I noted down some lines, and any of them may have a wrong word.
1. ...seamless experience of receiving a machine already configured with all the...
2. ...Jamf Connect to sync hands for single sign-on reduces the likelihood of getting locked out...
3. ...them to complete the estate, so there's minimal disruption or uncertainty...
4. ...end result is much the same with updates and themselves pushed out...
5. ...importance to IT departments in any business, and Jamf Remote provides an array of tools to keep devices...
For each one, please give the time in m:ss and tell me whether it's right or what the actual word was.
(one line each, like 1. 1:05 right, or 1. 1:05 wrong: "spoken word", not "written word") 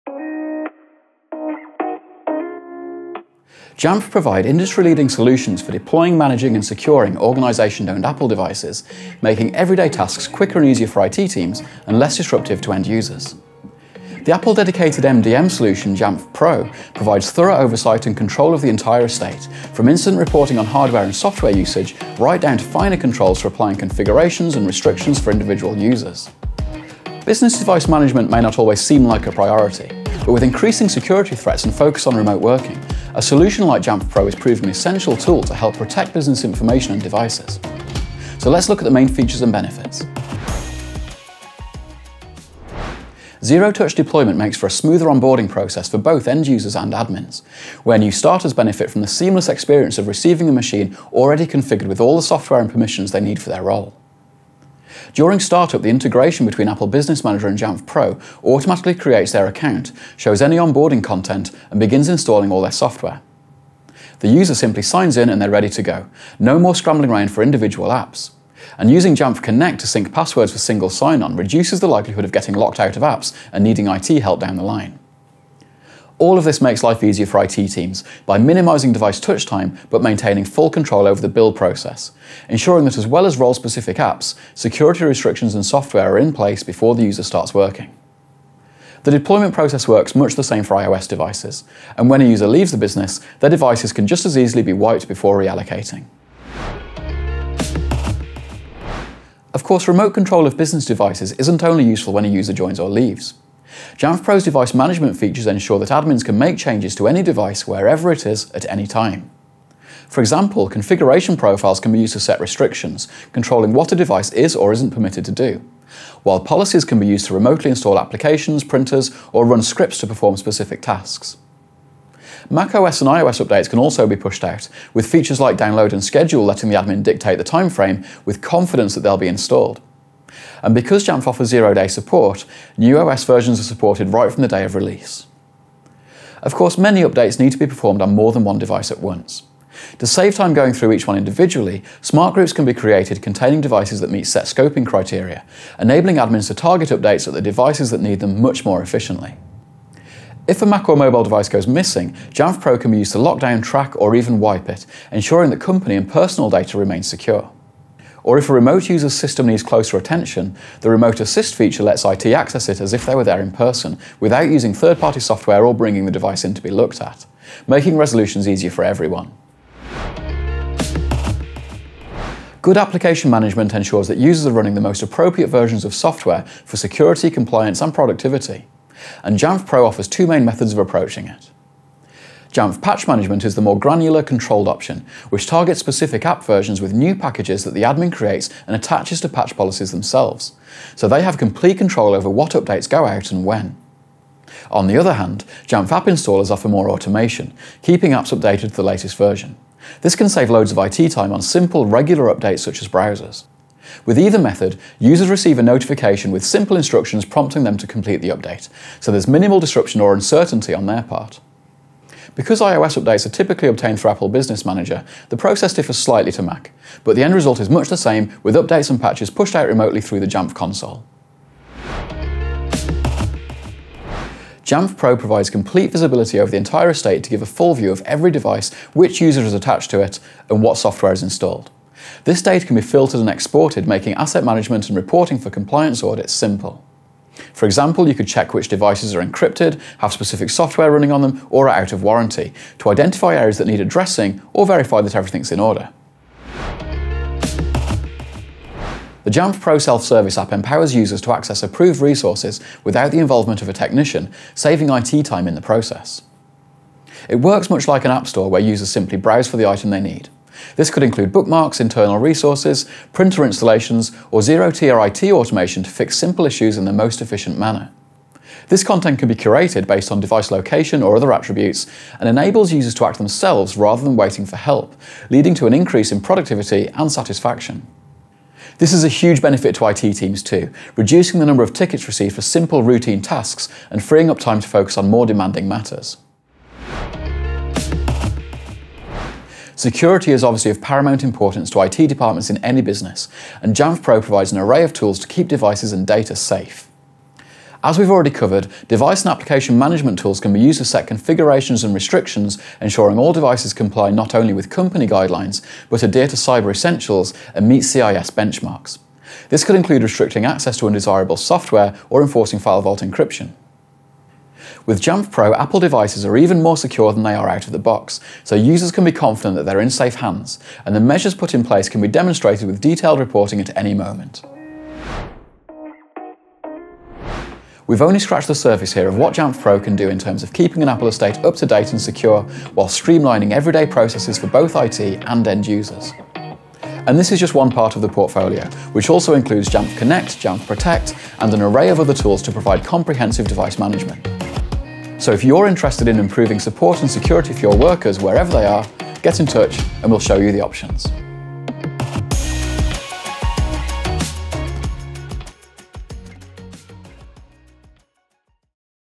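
1. 0:49 right
2. 1:09 wrong: "passwords", not "hands"
3. 3:27 wrong: "update", not "estate"
4. 3:37 wrong: "patches", not "themselves"
5. 4:51 wrong: "Pro", not "Remote".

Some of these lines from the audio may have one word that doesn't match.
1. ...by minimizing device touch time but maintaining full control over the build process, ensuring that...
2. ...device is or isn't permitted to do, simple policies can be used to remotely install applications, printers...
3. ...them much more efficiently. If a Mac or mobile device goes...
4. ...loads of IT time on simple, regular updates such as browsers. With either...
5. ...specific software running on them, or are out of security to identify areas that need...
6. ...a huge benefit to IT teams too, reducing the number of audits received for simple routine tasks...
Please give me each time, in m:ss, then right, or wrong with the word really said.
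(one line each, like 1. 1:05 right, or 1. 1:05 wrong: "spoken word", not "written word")
1. 1:18 right
2. 1:53 wrong: "while", not "simple"
3. 2:28 right
4. 3:20 right
5. 4:00 wrong: "warranty", not "security"
6. 4:39 wrong: "tickets", not "audits".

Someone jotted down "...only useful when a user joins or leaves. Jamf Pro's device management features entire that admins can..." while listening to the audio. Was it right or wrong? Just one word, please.
wrong.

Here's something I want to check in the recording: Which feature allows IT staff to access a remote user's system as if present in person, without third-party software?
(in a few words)
Remote Assist.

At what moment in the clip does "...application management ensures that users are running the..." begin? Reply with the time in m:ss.
2:52.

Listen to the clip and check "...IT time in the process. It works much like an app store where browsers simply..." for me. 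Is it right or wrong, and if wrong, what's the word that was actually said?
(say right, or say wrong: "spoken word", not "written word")
wrong: "users", not "browsers".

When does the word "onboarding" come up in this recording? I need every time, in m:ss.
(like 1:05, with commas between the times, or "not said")
0:45, 1:00.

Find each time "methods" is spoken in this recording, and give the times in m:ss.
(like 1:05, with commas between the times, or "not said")
3:00, 3:24.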